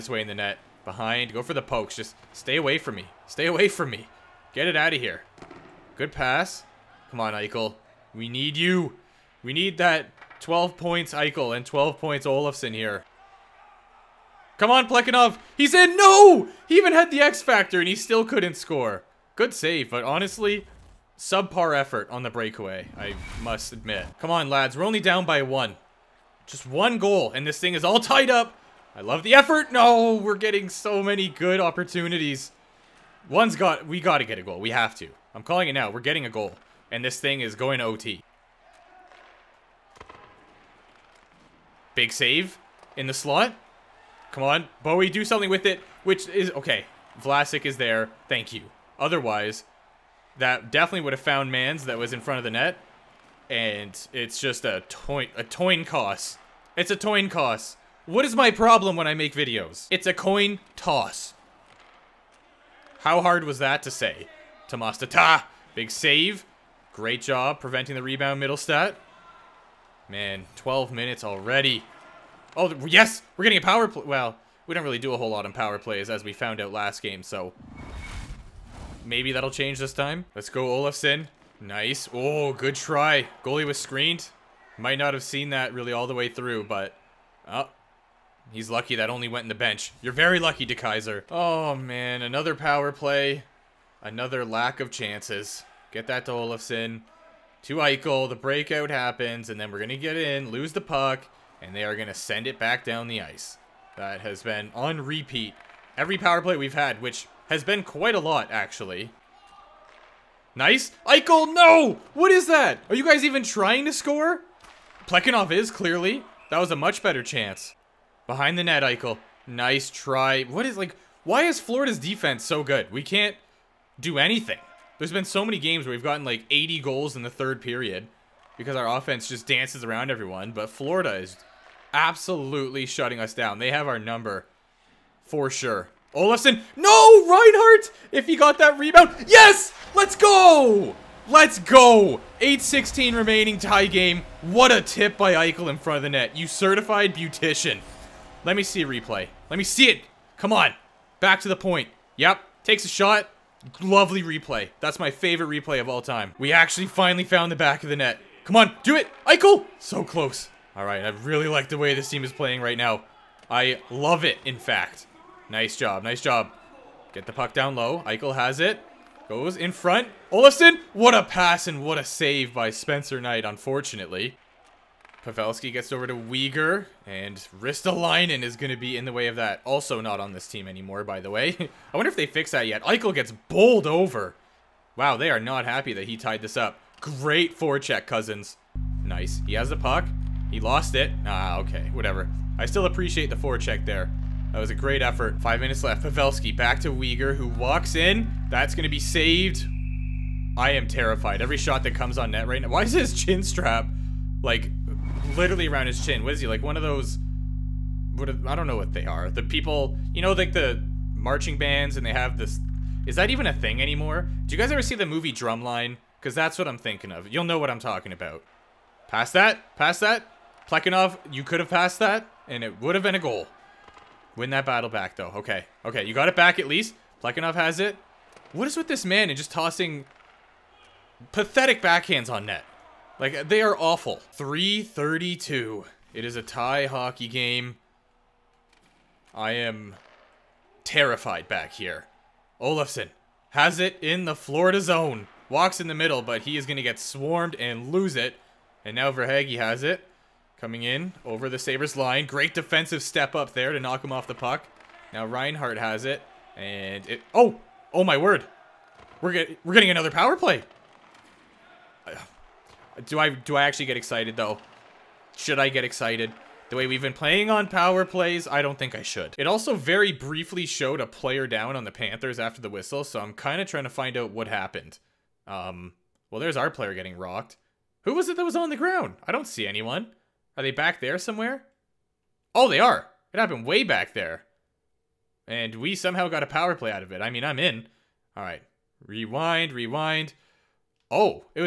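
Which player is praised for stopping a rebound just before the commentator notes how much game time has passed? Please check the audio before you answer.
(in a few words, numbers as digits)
Mittelstadt.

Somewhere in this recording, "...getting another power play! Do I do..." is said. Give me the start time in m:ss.
4:19.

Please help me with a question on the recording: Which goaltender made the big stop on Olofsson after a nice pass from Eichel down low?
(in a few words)
Spencer Knight.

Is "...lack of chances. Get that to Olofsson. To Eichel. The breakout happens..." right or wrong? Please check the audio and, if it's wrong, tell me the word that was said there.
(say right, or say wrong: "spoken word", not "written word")
right.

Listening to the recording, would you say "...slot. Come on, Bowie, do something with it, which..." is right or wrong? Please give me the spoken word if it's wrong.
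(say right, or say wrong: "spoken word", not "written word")
right.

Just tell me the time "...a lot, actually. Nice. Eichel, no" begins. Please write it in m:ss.
1:48.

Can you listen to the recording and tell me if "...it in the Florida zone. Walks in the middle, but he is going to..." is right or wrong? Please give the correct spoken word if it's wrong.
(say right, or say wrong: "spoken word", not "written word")
right.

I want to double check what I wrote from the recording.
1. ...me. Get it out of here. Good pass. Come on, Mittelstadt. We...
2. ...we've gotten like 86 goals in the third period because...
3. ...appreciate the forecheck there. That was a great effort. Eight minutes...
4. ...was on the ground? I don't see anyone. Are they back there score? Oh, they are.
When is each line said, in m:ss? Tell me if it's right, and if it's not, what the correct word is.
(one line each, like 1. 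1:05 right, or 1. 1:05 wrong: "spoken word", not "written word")
1. 0:03 wrong: "Eichel", not "Mittelstadt"
2. 2:05 wrong: "80", not "86"
3. 3:12 wrong: "Five", not "Eight"
4. 4:38 wrong: "somewhere", not "score".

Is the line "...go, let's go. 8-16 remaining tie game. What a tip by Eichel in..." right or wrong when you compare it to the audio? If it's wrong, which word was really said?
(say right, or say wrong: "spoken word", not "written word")
right.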